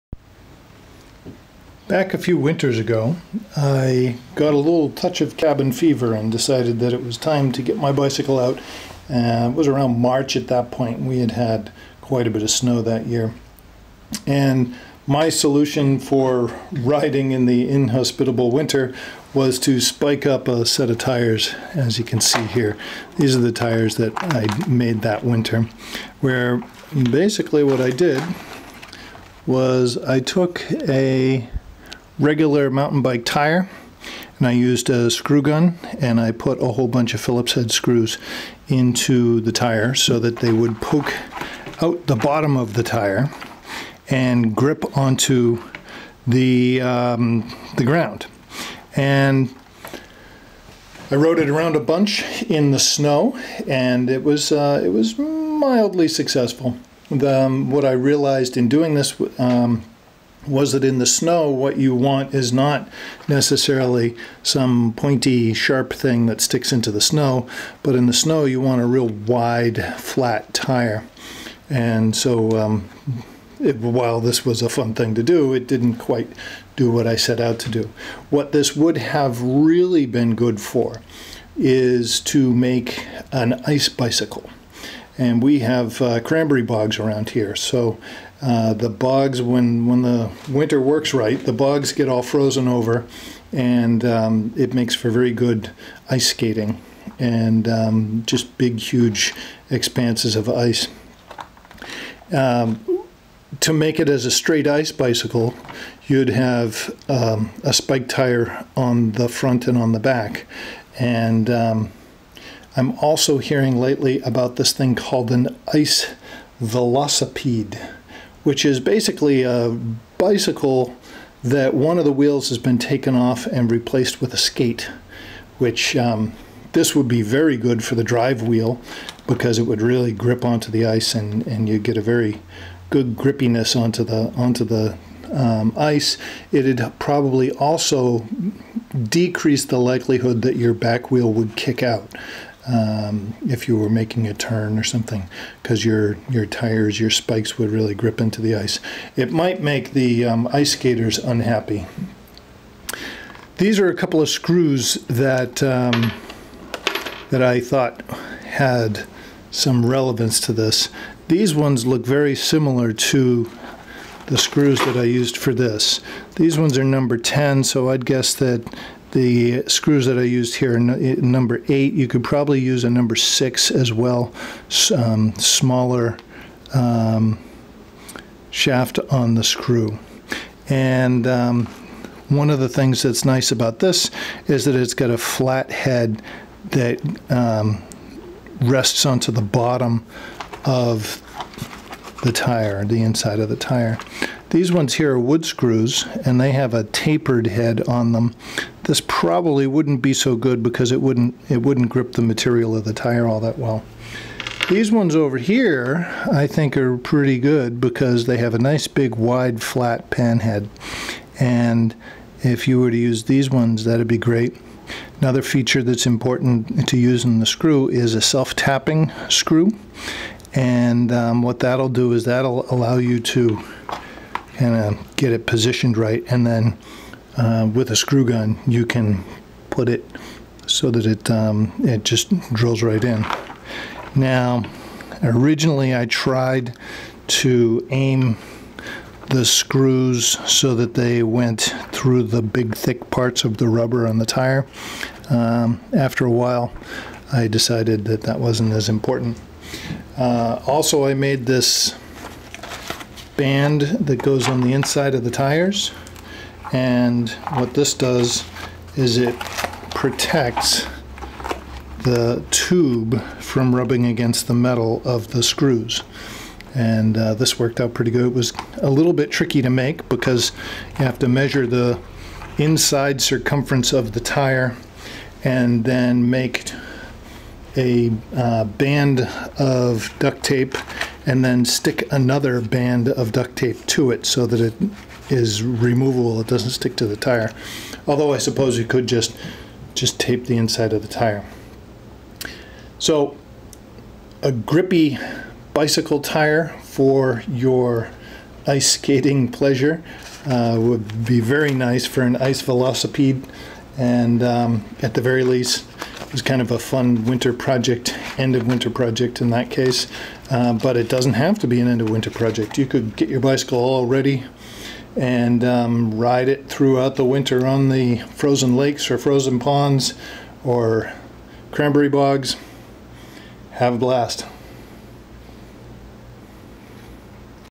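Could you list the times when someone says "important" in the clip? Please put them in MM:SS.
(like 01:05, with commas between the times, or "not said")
03:36, 04:08.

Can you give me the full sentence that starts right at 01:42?
Um, to make it as a straight ice bicycle, you'd have um, a spike tire on the front and on the back.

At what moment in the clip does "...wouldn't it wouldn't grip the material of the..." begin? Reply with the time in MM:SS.
03:21.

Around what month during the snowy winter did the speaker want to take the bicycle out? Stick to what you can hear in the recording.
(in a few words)
March.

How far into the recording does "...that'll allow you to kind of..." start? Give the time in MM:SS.
03:42.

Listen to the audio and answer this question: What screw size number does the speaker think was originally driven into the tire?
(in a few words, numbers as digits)
8.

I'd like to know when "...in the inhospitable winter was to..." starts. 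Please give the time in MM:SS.
00:17.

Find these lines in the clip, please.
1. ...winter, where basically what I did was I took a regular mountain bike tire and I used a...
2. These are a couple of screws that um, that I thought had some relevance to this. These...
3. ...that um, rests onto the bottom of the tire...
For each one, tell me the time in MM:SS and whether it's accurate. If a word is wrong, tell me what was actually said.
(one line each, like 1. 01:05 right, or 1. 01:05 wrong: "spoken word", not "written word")
1. 00:25 right
2. 02:33 right
3. 03:06 right.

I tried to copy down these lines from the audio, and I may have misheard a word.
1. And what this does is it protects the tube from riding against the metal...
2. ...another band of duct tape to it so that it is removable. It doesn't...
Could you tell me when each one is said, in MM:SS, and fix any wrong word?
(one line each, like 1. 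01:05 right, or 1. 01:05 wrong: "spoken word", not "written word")
1. 04:16 wrong: "rubbing", not "riding"
2. 04:42 right.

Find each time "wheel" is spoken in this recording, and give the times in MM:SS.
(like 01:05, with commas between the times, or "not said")
02:02, 02:08, 02:21.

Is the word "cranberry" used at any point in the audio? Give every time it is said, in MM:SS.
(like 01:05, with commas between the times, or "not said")
01:26, 05:21.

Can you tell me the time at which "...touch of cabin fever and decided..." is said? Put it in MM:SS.
00:04.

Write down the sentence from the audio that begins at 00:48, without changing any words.
And I rode it around a bunch in the snow and it was, uh, it was mildly successful.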